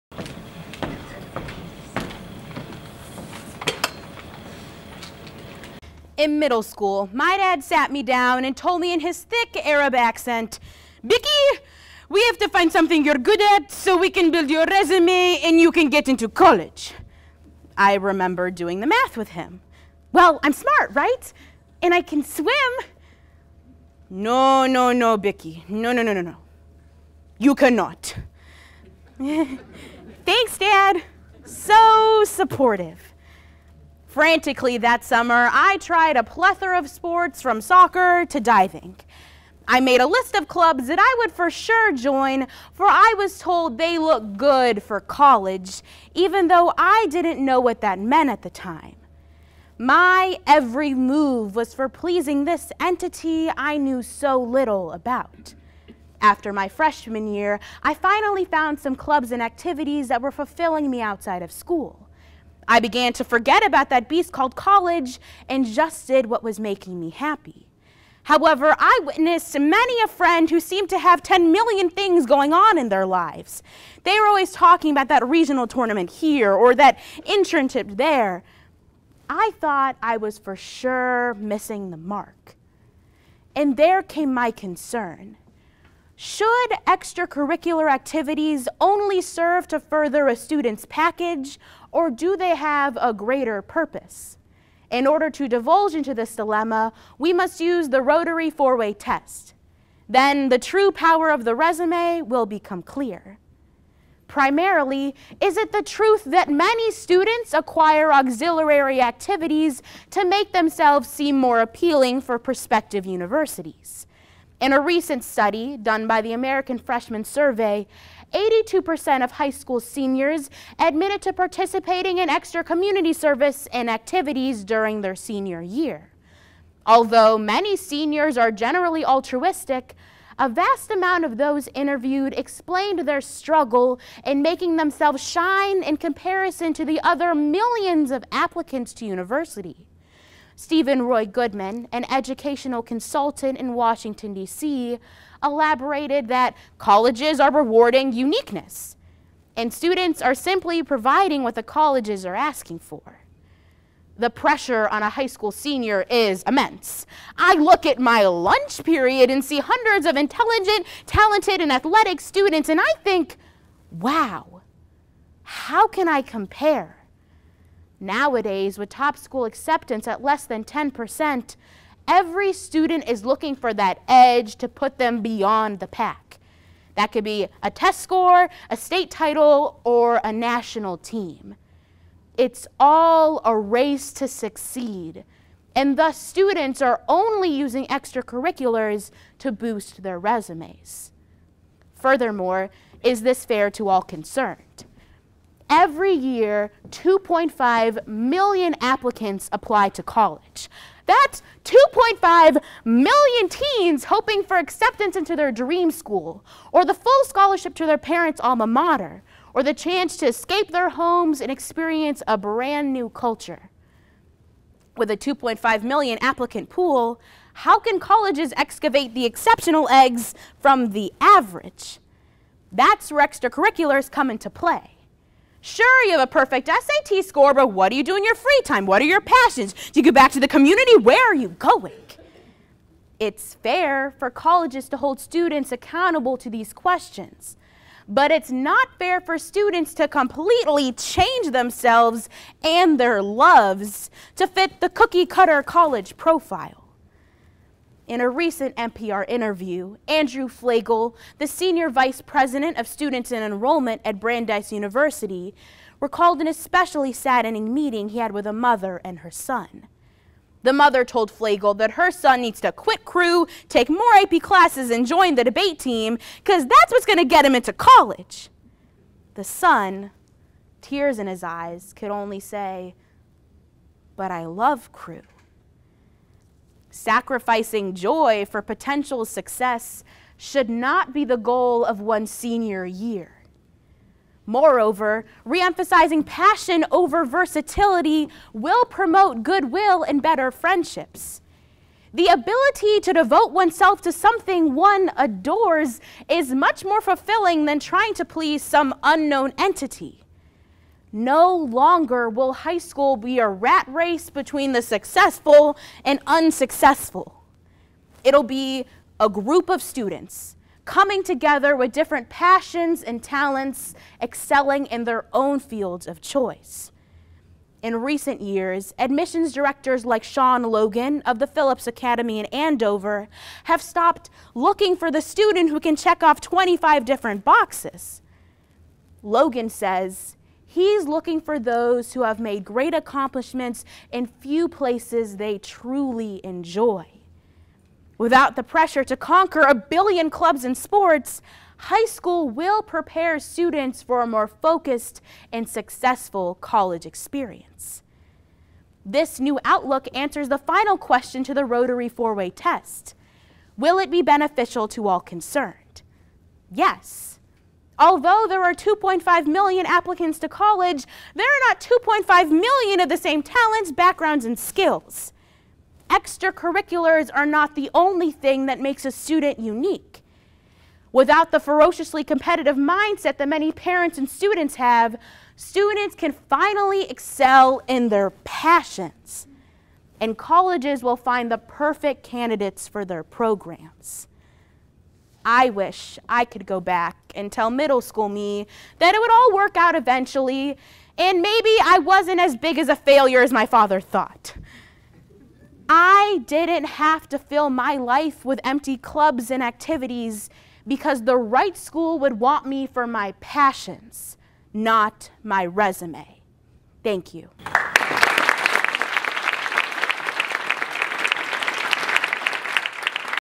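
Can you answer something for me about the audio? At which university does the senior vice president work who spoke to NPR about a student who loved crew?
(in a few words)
Brandeis University.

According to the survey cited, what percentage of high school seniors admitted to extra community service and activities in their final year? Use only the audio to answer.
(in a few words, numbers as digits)
82%.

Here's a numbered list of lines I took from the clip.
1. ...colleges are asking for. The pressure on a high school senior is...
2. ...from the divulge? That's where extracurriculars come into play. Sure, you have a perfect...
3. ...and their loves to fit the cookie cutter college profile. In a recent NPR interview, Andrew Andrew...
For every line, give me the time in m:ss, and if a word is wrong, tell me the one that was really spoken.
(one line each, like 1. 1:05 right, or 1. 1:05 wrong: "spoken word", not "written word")
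1. 2:31 right
2. 3:40 wrong: "average", not "divulge"
3. 4:02 wrong: "Flagel", not "Andrew".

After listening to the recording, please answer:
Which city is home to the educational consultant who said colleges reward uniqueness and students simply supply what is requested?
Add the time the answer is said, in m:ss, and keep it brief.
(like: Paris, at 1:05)
Washington, D.C., at 2:23.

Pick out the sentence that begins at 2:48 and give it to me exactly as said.
Nowadays, with top school acceptance at less than 10%, every student is looking for that edge to put them beyond the pack.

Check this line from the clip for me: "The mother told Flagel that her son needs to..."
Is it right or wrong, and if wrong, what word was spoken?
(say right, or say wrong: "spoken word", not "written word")
right.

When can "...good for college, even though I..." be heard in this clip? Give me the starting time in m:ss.
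0:44.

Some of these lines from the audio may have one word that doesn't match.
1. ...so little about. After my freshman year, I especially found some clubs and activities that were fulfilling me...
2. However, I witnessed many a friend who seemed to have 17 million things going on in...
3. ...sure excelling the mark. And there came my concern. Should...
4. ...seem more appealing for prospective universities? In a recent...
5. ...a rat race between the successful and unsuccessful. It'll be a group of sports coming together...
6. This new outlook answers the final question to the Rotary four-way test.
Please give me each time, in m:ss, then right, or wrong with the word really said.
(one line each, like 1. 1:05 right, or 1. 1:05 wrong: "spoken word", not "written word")
1. 0:54 wrong: "finally", not "especially"
2. 1:08 wrong: "10", not "17"
3. 1:20 wrong: "missing", not "excelling"
4. 1:51 right
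5. 5:03 wrong: "students", not "sports"
6. 5:49 right.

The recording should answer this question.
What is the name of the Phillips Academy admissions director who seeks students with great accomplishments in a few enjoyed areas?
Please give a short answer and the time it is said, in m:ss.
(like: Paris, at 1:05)
Sean Logan, at 5:20.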